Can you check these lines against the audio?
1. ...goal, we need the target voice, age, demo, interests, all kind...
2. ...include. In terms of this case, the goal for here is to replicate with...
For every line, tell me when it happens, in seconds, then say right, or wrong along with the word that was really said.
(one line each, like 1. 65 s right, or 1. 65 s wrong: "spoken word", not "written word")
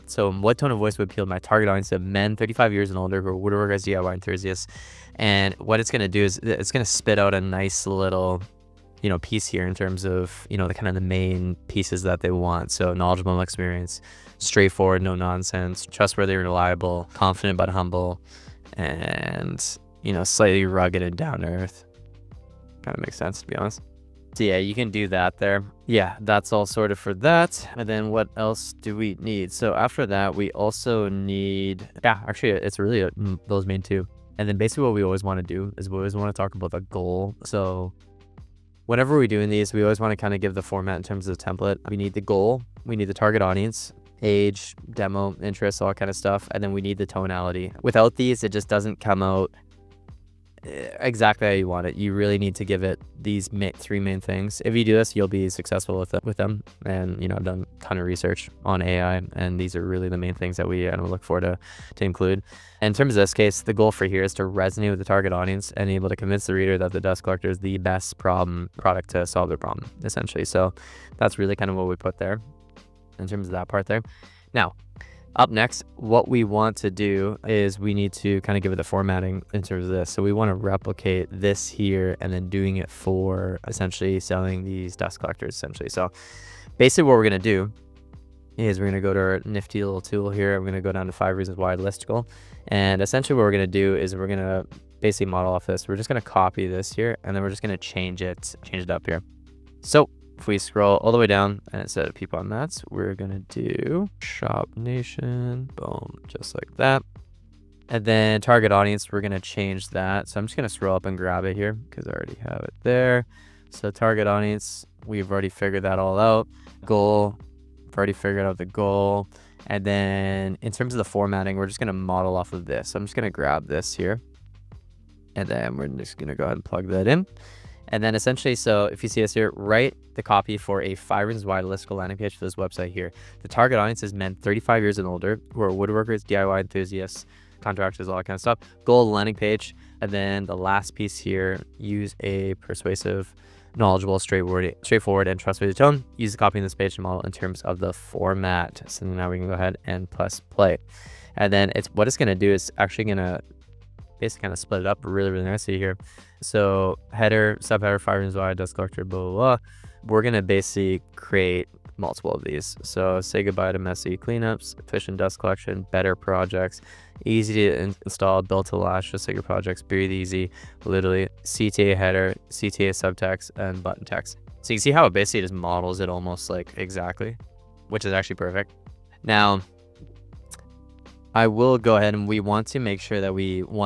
1. 42 s wrong: "audience", not "voice"
2. 62 s wrong: "resonate", not "replicate".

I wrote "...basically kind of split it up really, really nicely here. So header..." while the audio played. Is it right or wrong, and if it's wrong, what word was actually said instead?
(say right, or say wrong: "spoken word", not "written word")
right.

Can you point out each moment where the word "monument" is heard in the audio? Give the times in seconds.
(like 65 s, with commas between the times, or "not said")
not said.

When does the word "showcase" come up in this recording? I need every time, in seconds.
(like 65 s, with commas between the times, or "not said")
not said.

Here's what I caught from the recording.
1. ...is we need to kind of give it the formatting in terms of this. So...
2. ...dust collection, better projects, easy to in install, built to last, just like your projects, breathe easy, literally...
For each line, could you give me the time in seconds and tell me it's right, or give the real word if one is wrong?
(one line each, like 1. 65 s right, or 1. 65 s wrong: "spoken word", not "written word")
1. 77 s right
2. 165 s right.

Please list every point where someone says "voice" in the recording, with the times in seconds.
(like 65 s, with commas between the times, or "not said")
0 s.